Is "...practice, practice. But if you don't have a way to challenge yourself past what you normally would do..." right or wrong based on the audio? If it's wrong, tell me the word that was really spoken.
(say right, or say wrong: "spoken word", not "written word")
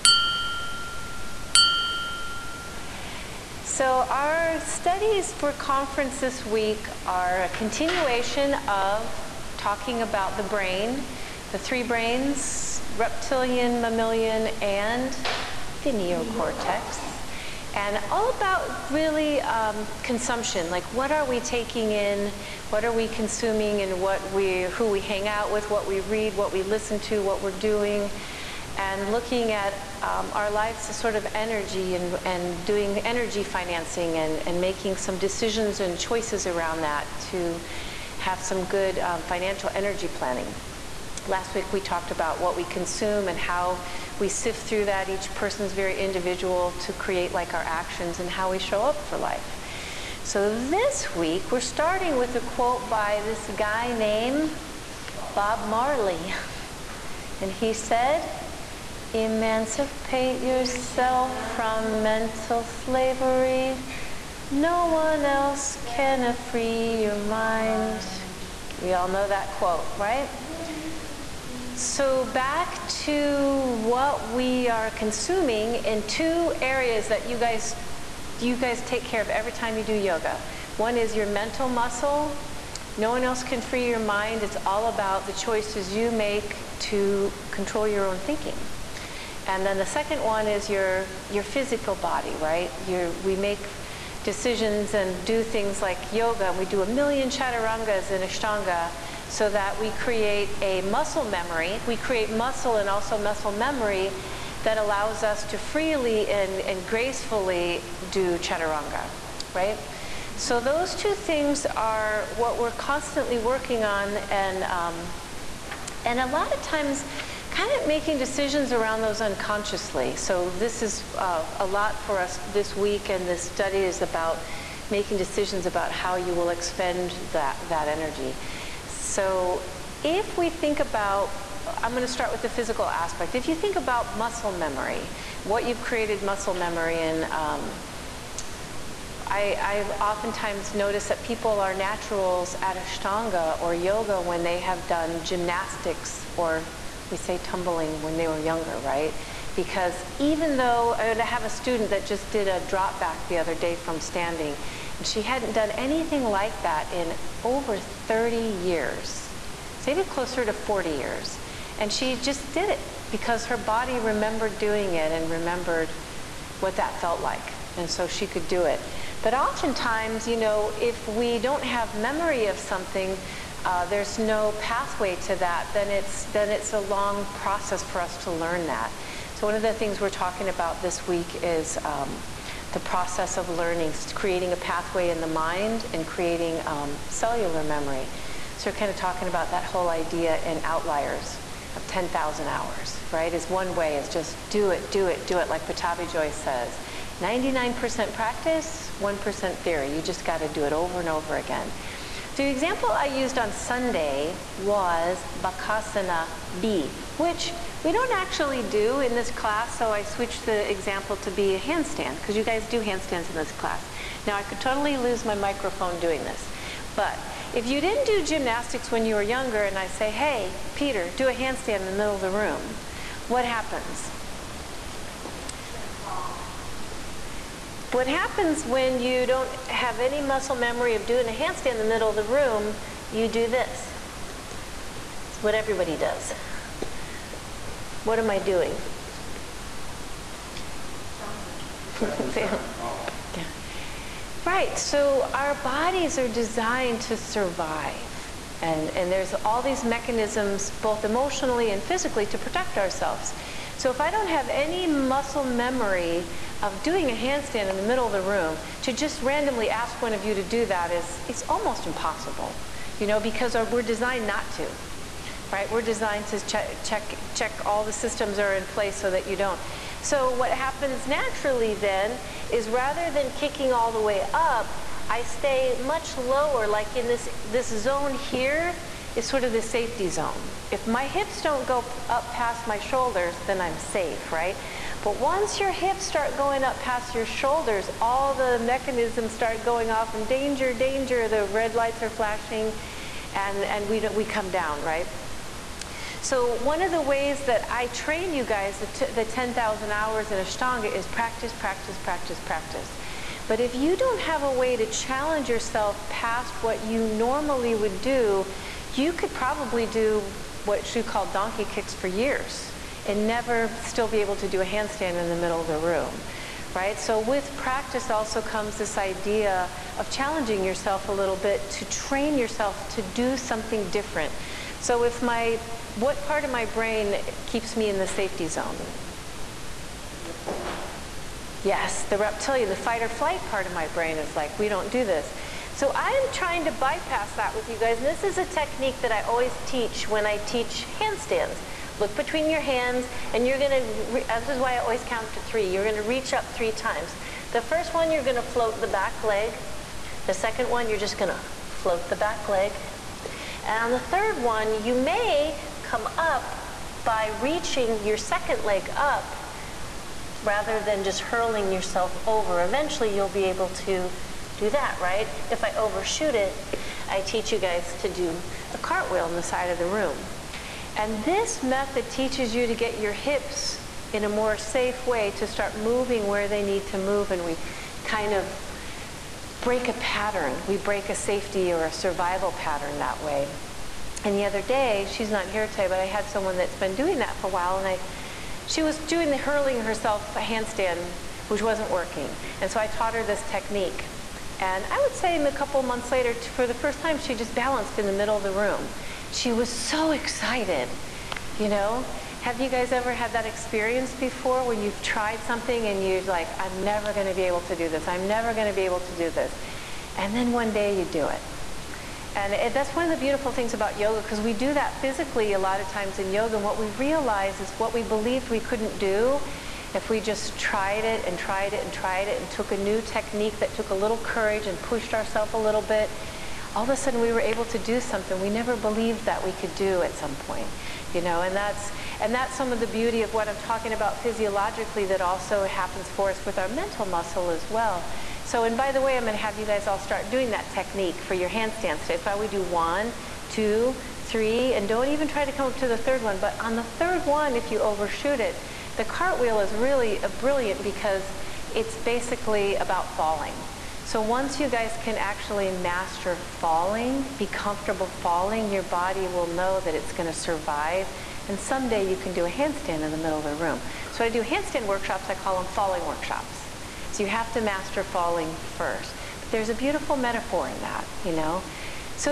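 right.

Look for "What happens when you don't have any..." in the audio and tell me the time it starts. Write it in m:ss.
3:47.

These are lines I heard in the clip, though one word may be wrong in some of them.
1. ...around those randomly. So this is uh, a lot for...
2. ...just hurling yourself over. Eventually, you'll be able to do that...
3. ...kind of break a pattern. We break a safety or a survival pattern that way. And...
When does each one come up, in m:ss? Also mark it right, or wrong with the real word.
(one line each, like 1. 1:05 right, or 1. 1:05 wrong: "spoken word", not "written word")
1. 1:58 wrong: "unconsciously", not "randomly"
2. 6:01 right
3. 6:18 right.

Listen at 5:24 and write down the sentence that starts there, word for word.
So if my what part of my brain keeps me in the safety zone?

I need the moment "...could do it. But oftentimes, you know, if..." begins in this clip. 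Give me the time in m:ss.
2:48.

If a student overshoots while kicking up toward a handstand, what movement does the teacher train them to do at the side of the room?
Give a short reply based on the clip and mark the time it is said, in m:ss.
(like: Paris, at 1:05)
a cartwheel, at 6:08.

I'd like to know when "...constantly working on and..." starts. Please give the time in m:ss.
1:52.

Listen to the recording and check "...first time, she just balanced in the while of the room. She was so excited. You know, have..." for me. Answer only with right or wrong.
wrong.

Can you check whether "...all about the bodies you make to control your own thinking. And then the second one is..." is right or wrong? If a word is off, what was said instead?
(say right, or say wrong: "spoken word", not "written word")
wrong: "choices", not "bodies".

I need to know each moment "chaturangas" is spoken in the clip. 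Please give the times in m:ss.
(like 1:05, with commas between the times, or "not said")
1:37, 1:48.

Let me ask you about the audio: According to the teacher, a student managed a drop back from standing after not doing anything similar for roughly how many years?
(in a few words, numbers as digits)
40 years.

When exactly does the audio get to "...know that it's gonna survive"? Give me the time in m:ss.
7:39.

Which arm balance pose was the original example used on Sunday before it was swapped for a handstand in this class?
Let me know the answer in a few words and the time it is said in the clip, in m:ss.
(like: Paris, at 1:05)
Bakasana B, at 3:25.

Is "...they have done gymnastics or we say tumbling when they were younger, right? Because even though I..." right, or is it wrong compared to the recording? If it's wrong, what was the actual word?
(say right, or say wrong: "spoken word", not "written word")
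right.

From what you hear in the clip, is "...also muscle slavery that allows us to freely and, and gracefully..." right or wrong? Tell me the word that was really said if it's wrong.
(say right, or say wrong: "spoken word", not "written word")
wrong: "memory", not "slavery".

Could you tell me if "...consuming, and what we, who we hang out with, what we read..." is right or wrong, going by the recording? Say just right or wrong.
right.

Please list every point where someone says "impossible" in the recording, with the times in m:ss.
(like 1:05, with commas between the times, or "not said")
4:21.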